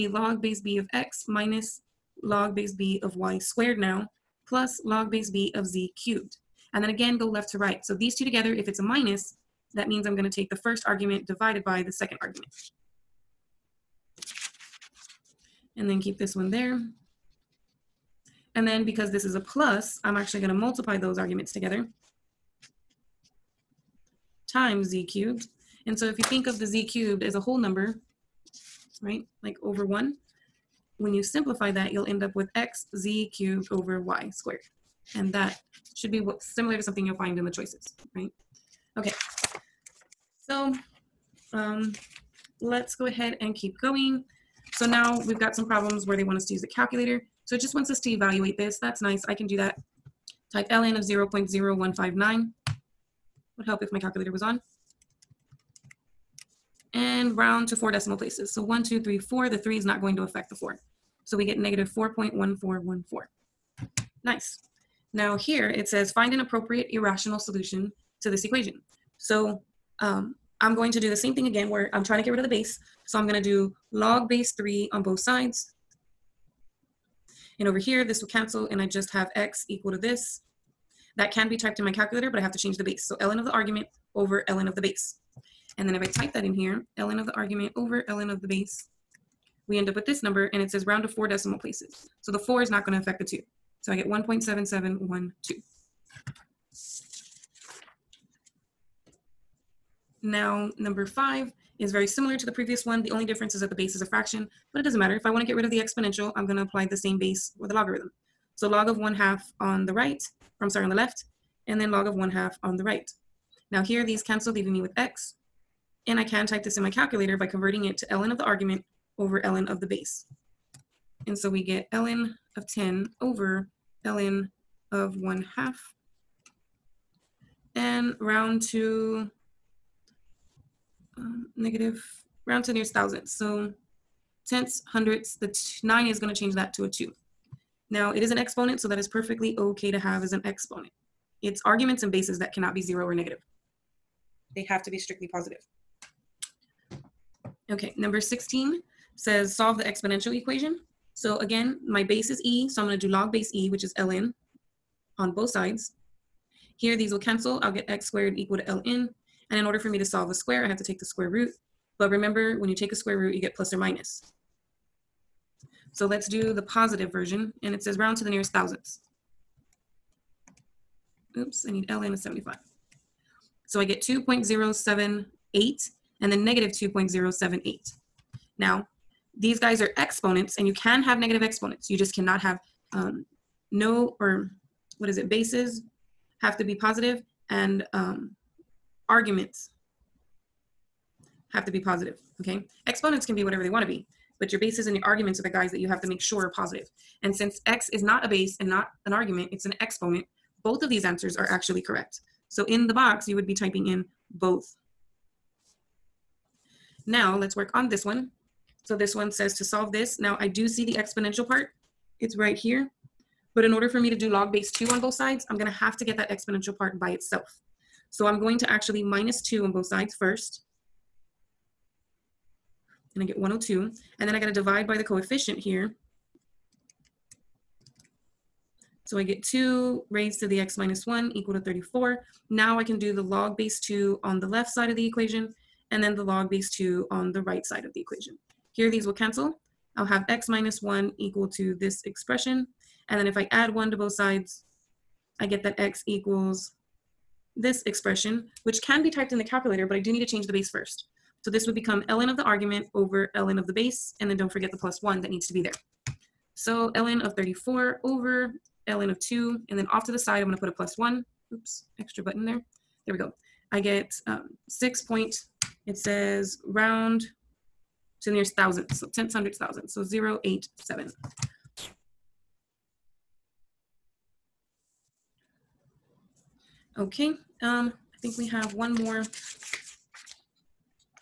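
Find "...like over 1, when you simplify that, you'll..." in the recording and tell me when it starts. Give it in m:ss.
0:29.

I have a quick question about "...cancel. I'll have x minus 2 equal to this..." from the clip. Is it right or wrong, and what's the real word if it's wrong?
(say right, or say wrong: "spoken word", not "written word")
wrong: "1", not "2".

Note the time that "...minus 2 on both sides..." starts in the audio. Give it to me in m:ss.
3:39.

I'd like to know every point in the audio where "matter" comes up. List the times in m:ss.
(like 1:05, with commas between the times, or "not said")
1:44.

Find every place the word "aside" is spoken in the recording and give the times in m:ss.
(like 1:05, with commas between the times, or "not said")
not said.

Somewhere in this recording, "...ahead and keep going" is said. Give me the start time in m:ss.
0:43.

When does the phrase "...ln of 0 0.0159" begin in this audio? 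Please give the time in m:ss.
0:50.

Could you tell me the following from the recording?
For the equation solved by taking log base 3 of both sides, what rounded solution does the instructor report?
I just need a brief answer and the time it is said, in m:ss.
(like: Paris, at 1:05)
1.7712, at 1:34.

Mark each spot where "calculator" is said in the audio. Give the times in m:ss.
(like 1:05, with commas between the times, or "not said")
0:46, 0:53, 1:21, 1:56, 4:09.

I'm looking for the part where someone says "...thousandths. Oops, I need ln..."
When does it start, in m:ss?
2:48.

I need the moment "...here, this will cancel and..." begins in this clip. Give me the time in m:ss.
1:17.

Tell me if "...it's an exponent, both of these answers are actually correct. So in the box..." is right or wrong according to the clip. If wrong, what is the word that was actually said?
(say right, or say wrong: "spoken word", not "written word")
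right.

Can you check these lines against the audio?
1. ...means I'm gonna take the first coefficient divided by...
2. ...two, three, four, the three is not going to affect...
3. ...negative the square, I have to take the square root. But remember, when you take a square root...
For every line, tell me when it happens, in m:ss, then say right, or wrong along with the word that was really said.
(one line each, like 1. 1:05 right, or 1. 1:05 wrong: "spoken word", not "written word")
1. 0:09 wrong: "argument", not "coefficient"
2. 0:58 right
3. 2:40 wrong: "solve", not "negative".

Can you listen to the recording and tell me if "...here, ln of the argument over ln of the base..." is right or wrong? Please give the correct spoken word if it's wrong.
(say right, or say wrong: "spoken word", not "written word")
right.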